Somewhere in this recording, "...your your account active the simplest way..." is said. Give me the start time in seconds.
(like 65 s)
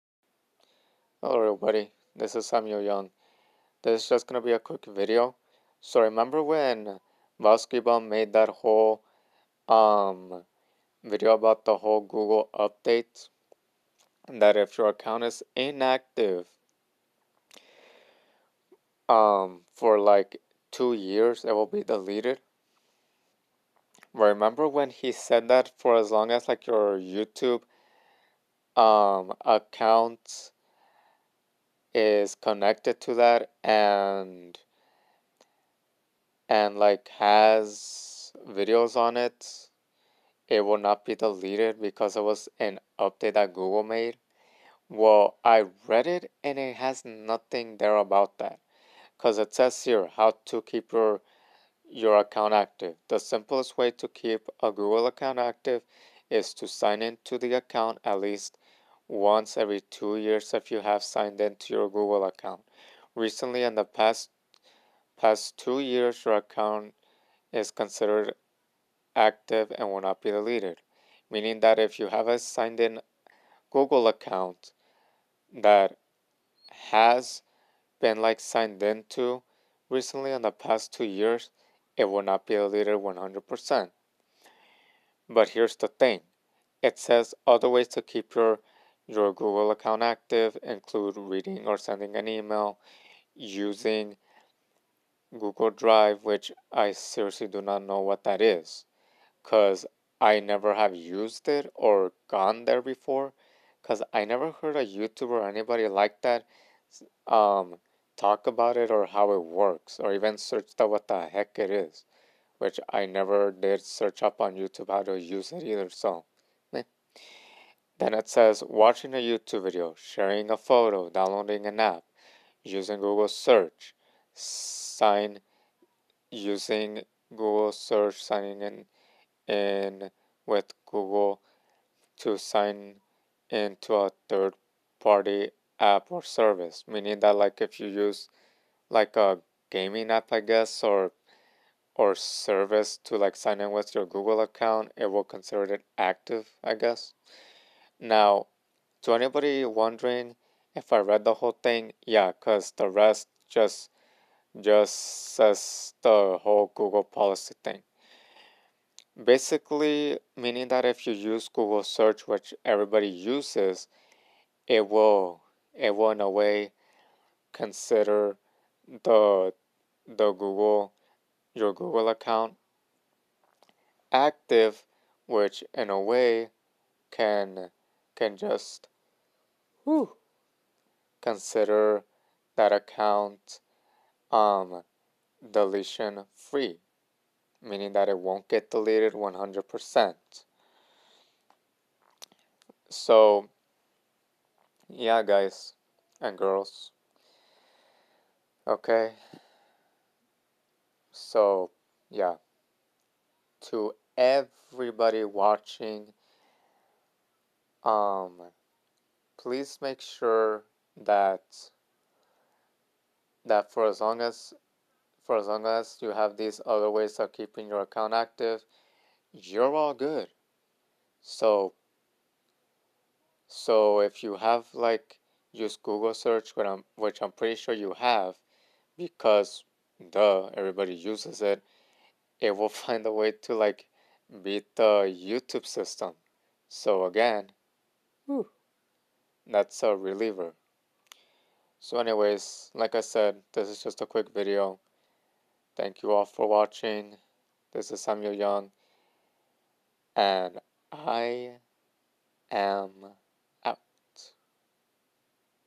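50 s.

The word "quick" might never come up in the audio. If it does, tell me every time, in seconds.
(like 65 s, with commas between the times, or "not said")
4 s, 244 s.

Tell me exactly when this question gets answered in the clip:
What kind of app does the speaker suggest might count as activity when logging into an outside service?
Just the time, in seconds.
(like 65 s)
139 s.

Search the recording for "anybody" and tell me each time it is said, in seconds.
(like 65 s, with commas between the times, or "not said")
105 s, 149 s.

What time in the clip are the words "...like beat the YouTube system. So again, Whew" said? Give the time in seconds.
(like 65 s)
233 s.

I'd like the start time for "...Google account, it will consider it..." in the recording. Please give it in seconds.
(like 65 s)
144 s.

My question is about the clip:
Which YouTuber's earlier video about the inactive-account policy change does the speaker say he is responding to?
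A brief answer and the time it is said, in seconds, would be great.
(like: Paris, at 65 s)
Vailskibum, at 7 s.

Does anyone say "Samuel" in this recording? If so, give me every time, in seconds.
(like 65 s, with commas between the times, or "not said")
2 s, 248 s.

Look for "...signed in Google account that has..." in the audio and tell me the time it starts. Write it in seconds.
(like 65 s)
72 s.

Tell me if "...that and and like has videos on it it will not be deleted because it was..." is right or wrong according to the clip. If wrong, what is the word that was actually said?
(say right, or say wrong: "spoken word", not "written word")
right.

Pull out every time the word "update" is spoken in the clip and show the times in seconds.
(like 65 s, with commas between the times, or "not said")
12 s, 42 s.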